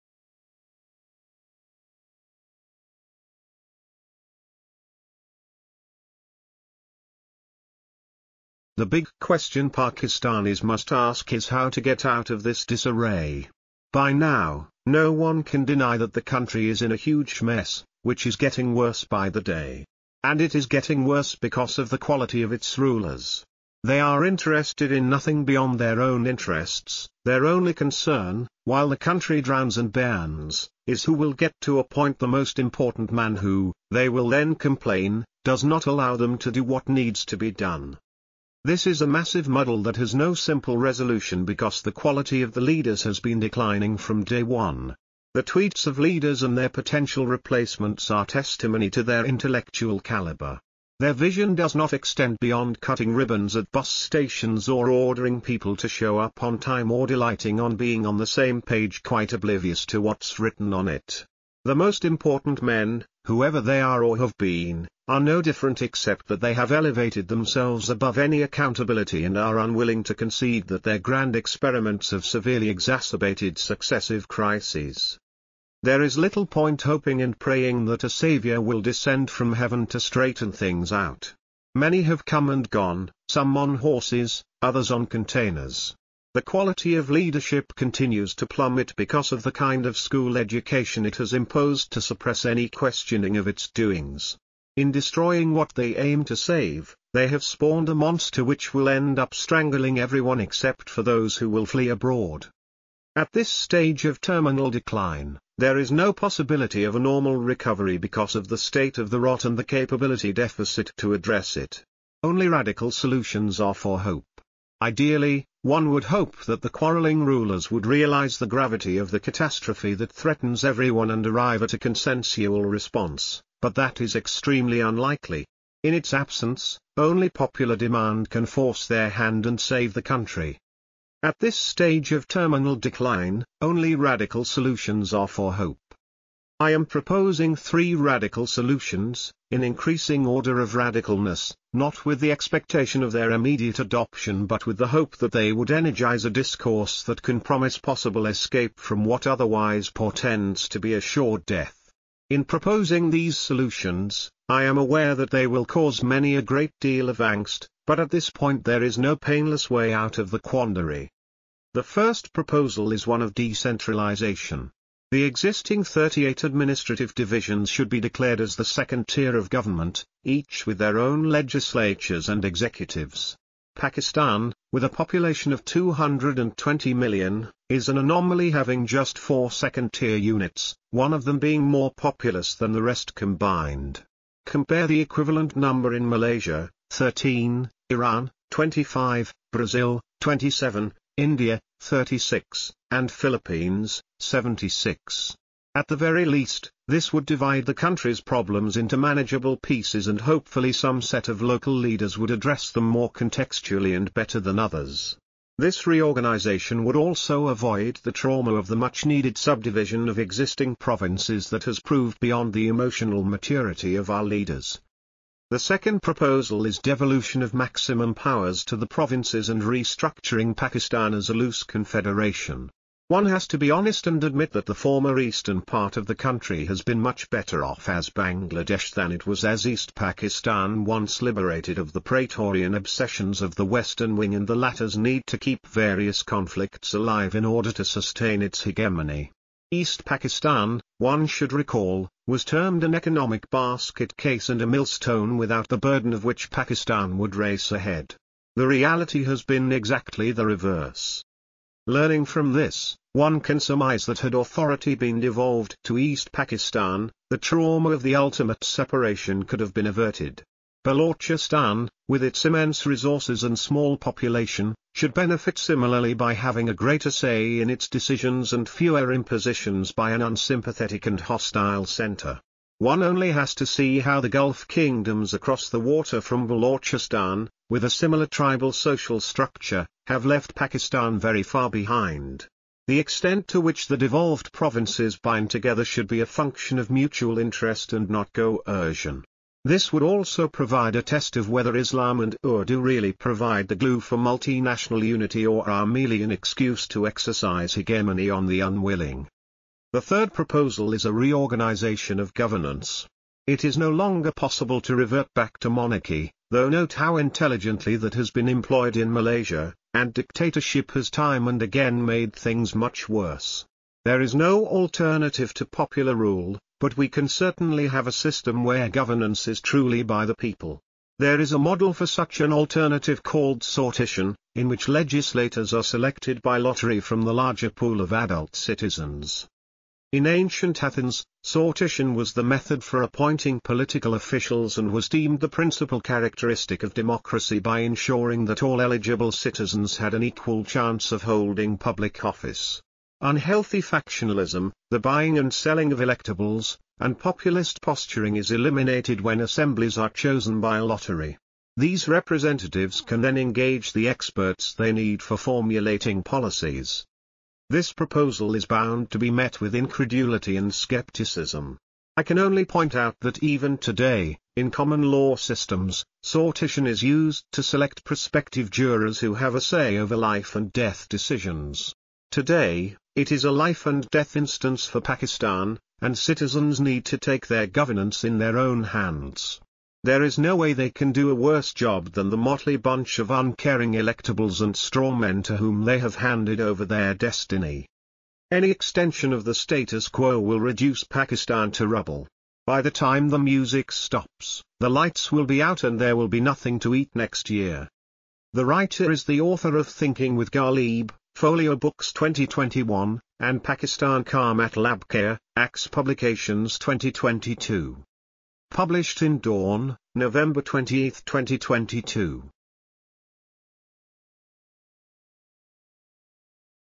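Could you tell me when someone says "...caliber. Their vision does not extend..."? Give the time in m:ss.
0:49.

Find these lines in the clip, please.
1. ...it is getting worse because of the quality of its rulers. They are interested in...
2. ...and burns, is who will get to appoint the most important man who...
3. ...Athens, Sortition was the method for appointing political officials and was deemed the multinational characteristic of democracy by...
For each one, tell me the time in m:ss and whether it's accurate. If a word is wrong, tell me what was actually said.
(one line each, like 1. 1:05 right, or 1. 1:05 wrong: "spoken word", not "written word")
1. 0:20 right
2. 0:29 right
3. 5:30 wrong: "principal", not "multinational".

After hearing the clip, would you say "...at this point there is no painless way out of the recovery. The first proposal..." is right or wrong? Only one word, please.
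wrong.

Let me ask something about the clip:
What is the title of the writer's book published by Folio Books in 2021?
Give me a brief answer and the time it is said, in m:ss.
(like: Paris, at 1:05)
Thinking with Ghalib, at 6:39.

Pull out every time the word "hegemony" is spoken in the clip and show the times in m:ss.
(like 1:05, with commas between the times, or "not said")
3:58, 4:57.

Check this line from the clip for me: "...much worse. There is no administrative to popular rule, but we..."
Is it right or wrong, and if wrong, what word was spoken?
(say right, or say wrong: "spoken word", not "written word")
wrong: "alternative", not "administrative".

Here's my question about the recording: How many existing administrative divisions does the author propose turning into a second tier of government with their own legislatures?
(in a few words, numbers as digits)
38.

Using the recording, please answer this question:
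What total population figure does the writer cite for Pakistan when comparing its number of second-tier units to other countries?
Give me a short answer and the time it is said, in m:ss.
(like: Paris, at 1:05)
220 million, at 2:55.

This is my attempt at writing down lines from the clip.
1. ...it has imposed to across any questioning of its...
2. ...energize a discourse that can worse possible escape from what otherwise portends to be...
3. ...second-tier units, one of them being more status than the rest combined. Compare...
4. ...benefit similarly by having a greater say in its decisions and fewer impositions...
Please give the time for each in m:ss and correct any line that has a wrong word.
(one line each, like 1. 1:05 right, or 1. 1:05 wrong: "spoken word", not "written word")
1. 1:31 wrong: "suppress", not "across"
2. 2:25 wrong: "promise", not "worse"
3. 2:59 wrong: "populous", not "status"
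4. 4:25 right.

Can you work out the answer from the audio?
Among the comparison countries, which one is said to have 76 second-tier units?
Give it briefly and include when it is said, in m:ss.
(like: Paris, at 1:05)
Philippines, at 3:13.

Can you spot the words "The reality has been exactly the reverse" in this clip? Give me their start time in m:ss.
4:08.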